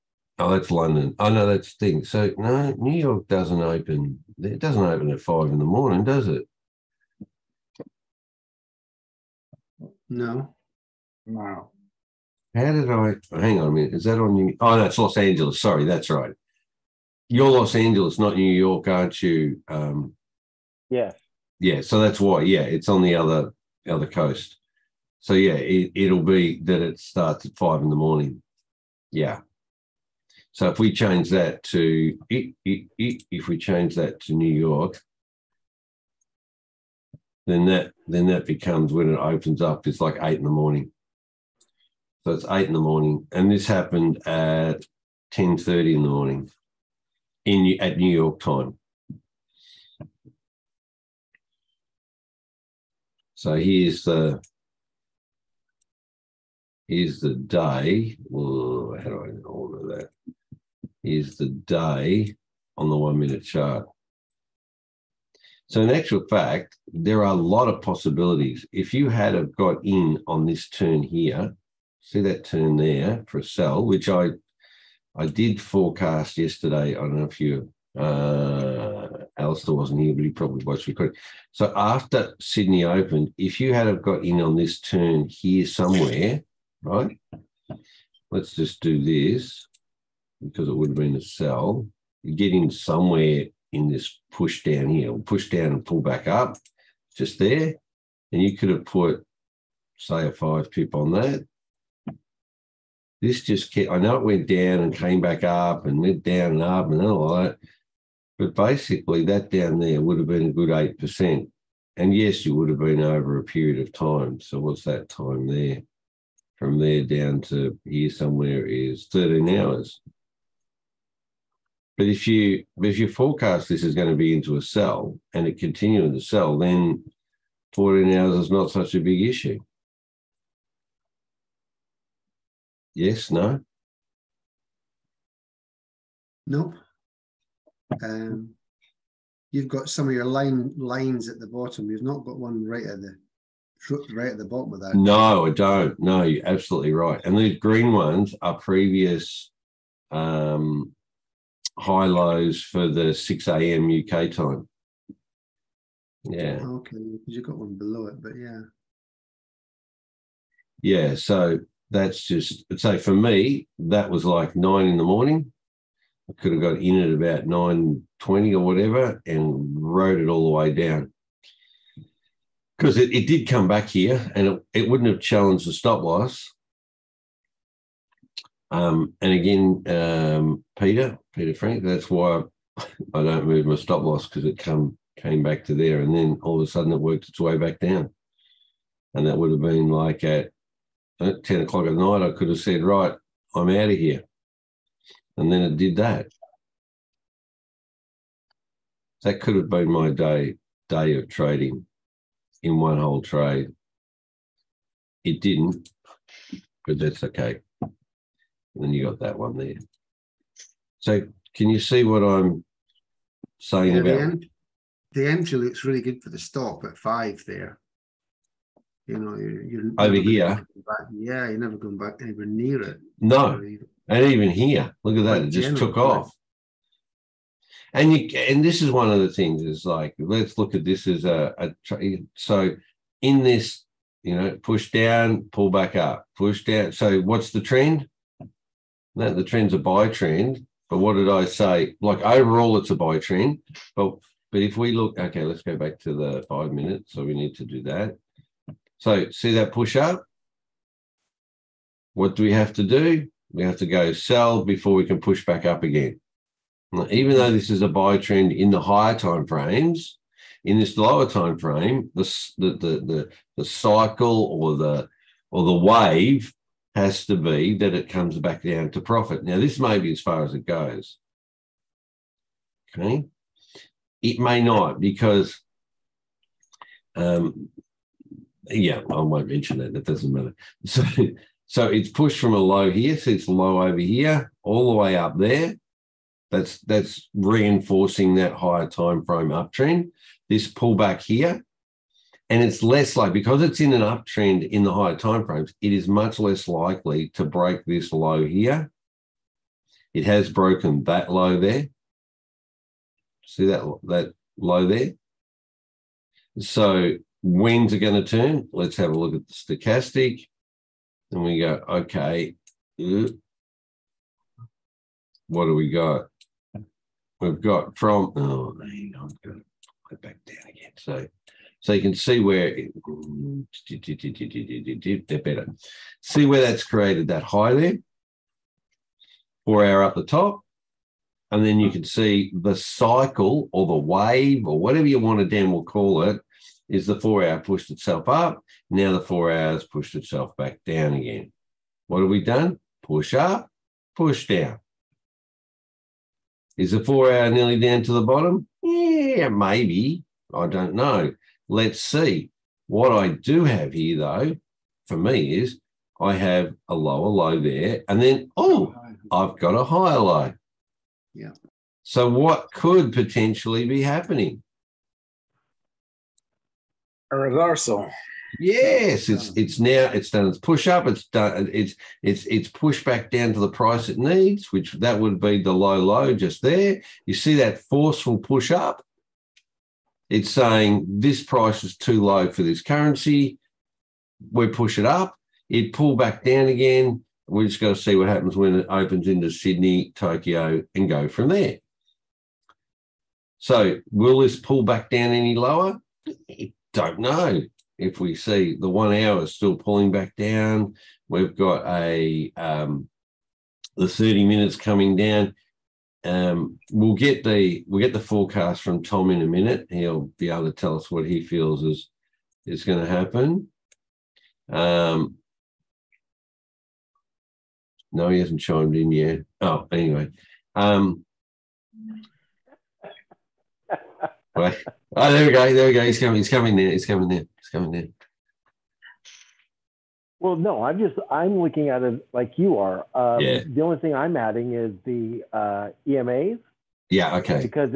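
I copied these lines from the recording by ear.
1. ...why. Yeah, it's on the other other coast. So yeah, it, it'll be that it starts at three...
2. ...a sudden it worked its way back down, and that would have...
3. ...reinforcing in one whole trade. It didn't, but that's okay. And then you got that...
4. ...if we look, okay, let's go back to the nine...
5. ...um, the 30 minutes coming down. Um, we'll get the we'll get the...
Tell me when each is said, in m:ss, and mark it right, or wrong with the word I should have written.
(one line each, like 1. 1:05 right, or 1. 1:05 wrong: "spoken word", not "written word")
1. 0:22 wrong: "five", not "three"
2. 3:06 right
3. 3:21 wrong: "trading", not "reinforcing"
4. 4:04 wrong: "five", not "nine"
5. 6:42 right.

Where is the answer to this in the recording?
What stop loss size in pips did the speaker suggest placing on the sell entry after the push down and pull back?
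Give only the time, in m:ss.
1:40.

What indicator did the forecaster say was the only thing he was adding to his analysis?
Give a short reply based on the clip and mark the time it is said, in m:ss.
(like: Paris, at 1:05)
EMAs, at 7:16.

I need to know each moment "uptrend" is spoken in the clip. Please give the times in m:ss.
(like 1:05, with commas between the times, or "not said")
4:49, 4:54.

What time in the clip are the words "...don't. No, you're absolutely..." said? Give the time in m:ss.
2:25.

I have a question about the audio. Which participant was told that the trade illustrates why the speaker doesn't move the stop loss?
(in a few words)
Peter Frank.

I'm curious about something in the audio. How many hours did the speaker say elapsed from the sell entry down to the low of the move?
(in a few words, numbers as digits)
13.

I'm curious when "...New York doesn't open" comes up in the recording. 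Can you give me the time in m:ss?
0:02.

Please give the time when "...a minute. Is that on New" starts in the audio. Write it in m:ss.
0:13.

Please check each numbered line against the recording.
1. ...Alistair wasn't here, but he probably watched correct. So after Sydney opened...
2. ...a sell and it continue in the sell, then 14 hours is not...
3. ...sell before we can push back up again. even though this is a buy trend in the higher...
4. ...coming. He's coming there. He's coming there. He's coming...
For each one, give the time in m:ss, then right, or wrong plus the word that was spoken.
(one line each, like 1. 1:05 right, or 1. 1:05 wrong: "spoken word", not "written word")
1. 1:19 right
2. 2:04 right
3. 4:14 right
4. 7:06 right.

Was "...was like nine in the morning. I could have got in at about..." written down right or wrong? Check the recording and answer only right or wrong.
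right.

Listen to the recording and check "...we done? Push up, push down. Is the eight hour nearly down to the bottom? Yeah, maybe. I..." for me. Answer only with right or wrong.
wrong.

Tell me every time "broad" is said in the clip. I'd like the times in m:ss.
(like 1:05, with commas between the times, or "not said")
not said.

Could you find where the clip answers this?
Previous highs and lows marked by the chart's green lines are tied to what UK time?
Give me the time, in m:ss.
2:33.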